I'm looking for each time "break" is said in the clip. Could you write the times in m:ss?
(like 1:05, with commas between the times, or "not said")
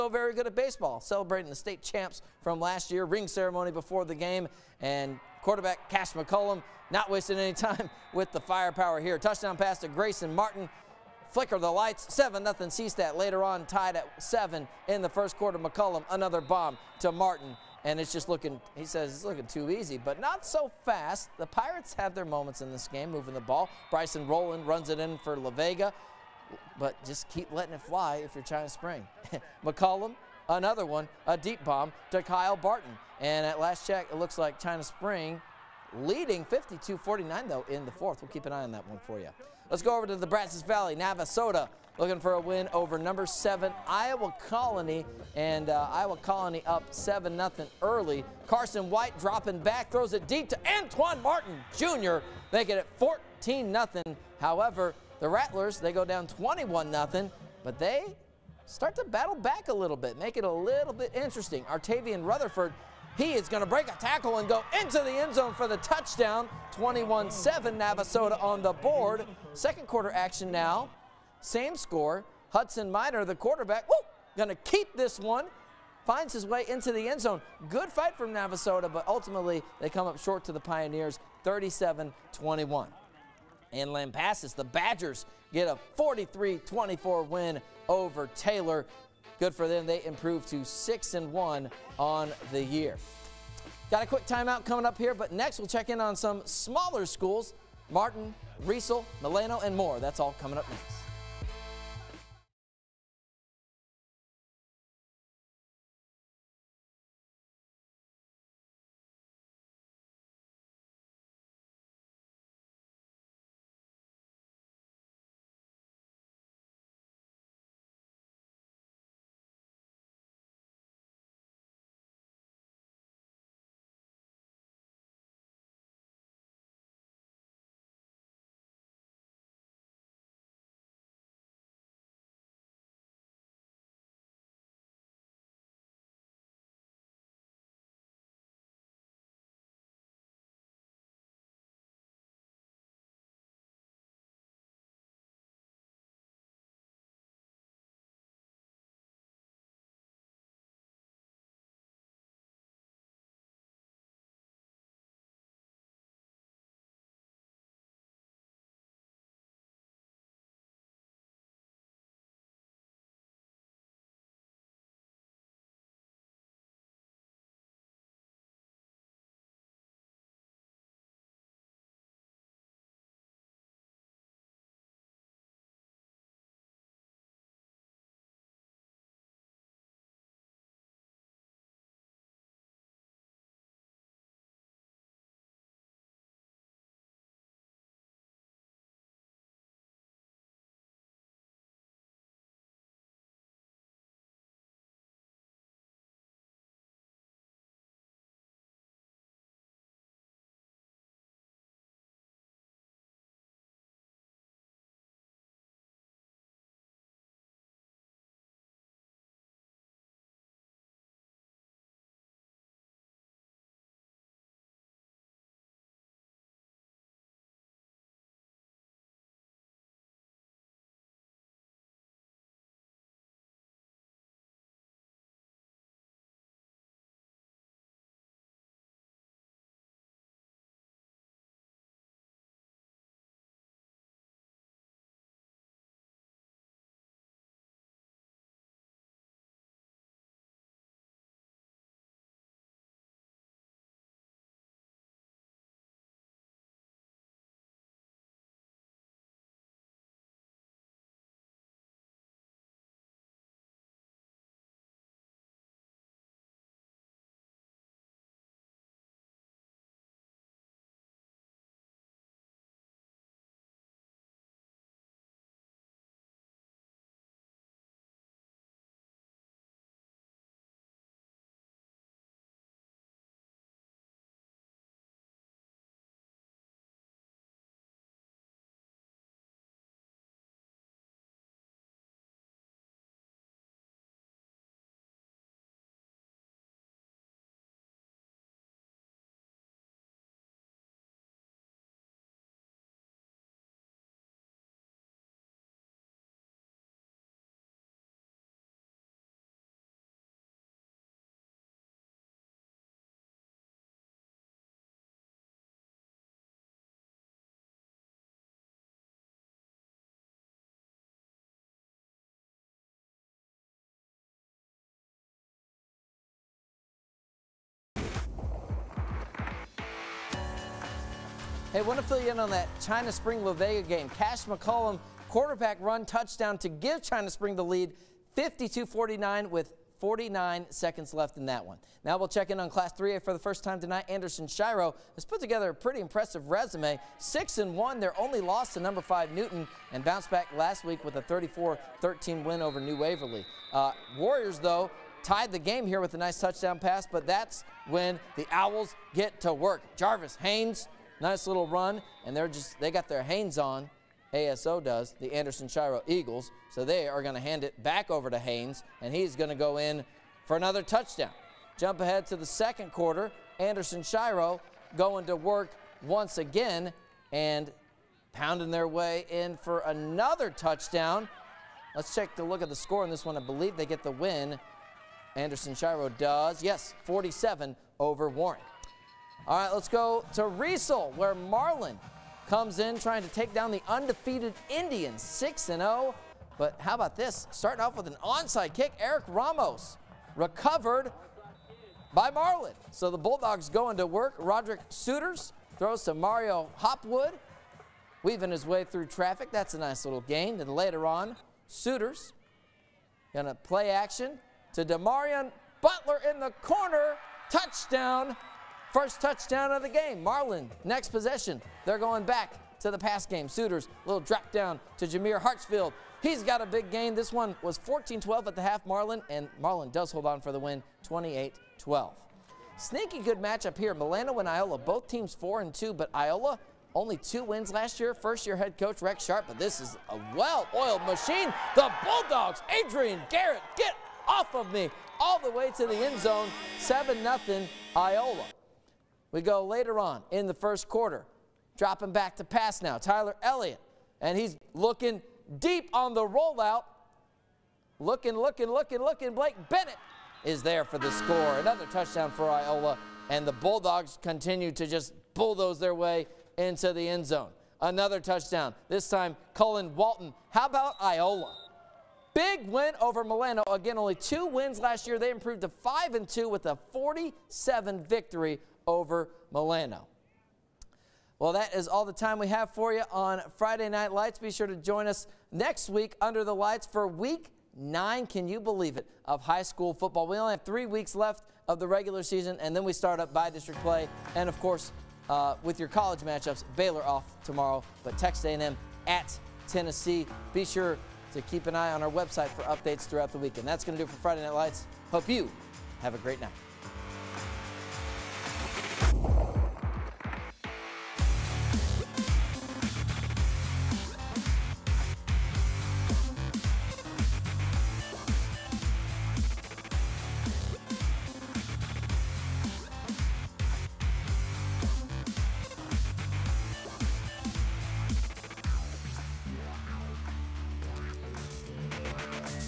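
1:03.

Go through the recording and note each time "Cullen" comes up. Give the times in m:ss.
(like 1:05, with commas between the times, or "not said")
7:39.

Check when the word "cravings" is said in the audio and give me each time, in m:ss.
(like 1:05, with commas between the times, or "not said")
not said.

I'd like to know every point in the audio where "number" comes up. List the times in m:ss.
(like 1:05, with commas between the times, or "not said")
0:42, 5:38.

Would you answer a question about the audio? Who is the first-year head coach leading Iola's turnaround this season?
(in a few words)
Rex Sharp.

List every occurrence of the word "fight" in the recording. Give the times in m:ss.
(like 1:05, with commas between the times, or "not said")
1:17.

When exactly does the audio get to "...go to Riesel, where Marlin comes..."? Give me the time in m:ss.
6:19.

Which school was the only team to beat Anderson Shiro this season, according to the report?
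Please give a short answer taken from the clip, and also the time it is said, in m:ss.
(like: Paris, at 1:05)
Newton, at 5:39.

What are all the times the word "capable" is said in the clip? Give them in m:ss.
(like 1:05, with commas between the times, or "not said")
not said.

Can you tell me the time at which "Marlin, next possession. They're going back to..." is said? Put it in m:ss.
6:50.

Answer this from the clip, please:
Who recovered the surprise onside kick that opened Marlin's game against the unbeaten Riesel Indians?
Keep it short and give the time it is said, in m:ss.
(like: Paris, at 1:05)
Eric Ramos, at 6:28.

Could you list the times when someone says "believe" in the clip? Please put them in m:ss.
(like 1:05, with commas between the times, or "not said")
6:13, 7:58.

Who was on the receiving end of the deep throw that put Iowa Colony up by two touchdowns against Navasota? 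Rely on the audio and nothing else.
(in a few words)
Antoine Martin Jr.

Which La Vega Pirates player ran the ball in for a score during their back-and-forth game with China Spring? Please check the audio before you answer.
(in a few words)
Bryson Rowland.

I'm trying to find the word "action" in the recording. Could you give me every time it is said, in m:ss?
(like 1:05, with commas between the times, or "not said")
1:10, 6:43.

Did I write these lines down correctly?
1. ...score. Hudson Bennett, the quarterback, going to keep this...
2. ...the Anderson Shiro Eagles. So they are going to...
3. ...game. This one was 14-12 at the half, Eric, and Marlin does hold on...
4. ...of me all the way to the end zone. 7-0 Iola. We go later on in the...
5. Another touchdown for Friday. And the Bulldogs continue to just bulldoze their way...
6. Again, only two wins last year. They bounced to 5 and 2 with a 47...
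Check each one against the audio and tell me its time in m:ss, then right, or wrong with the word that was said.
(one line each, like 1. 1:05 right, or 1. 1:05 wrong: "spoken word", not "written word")
1. 1:11 wrong: "Minor", not "Bennett"
2. 5:55 right
3. 6:56 wrong: "Marlin", not "Eric"
4. 7:14 right
5. 7:31 wrong: "Iola", not "Friday"
6. 7:43 wrong: "improved", not "bounced".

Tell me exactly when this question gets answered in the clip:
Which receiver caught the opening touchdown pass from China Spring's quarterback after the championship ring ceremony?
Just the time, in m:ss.
0:09.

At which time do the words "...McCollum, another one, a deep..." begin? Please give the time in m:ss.
0:29.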